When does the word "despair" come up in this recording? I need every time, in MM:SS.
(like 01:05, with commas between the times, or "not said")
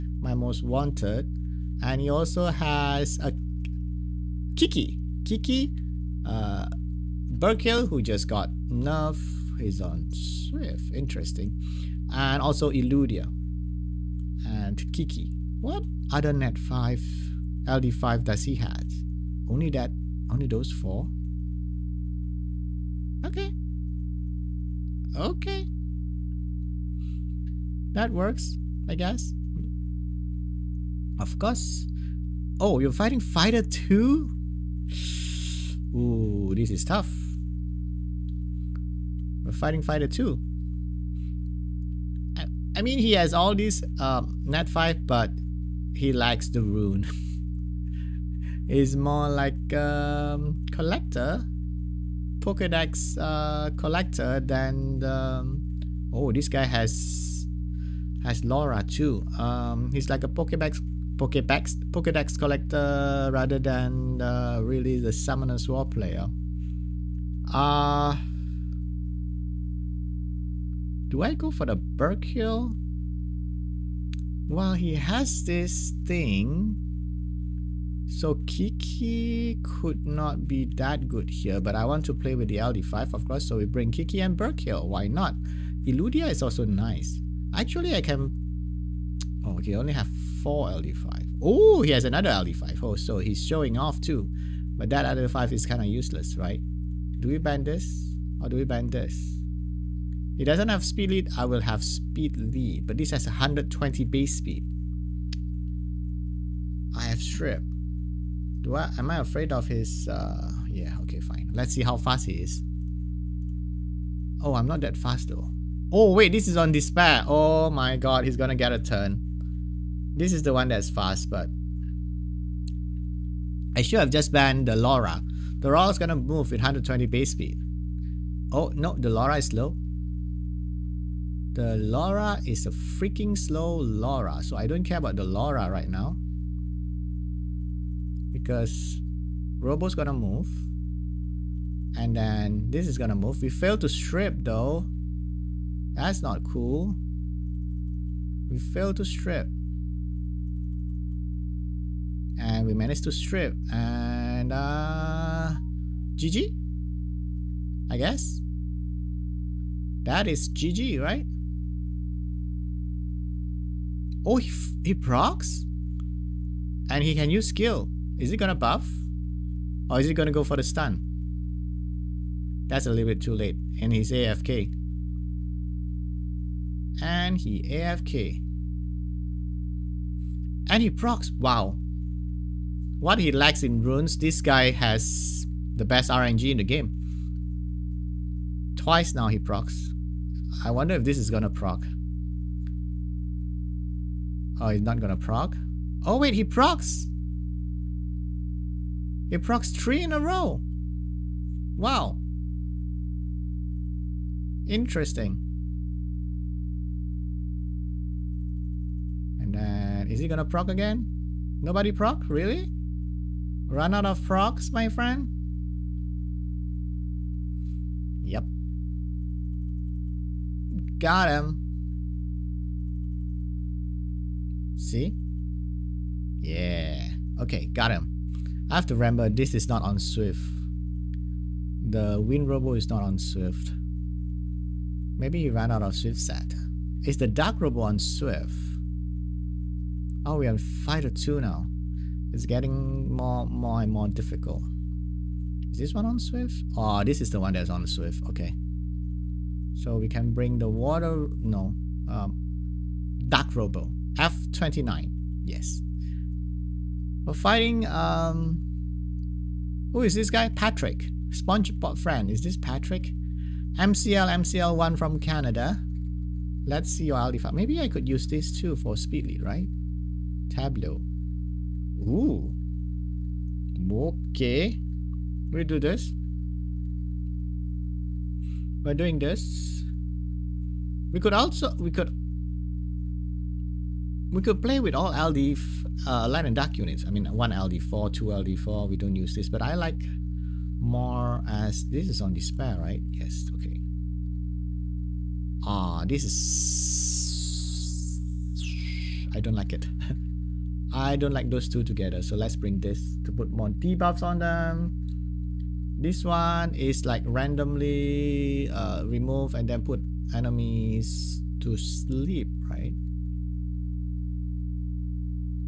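01:56, 04:52.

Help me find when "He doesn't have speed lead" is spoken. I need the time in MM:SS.
01:40.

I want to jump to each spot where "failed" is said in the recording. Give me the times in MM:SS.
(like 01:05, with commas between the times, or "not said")
02:23, 02:28.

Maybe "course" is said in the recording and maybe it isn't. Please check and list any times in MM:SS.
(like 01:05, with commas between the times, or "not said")
00:31, 01:23.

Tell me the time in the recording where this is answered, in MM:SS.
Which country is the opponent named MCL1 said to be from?
04:25.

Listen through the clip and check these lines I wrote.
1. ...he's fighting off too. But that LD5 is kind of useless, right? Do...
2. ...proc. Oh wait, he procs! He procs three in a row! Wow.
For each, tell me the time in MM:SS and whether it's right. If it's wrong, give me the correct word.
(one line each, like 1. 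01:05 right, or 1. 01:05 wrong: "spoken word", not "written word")
1. 01:33 wrong: "showing", not "fighting"
2. 03:15 right.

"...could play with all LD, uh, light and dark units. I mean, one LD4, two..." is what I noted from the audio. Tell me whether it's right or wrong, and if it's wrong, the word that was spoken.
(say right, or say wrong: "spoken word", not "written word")
right.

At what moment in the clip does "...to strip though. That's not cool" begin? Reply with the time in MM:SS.
02:23.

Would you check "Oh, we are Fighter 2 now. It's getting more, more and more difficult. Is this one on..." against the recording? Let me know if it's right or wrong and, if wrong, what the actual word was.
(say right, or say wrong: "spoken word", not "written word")
right.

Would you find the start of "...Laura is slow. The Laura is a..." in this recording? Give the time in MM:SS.
02:09.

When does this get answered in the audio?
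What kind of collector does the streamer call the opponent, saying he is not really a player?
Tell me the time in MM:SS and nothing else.
01:01.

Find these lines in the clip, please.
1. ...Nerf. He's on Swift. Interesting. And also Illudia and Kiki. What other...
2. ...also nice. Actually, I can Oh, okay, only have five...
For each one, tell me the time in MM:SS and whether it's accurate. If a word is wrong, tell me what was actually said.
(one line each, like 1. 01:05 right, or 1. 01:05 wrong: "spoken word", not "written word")
1. 00:08 right
2. 01:26 wrong: "four", not "five".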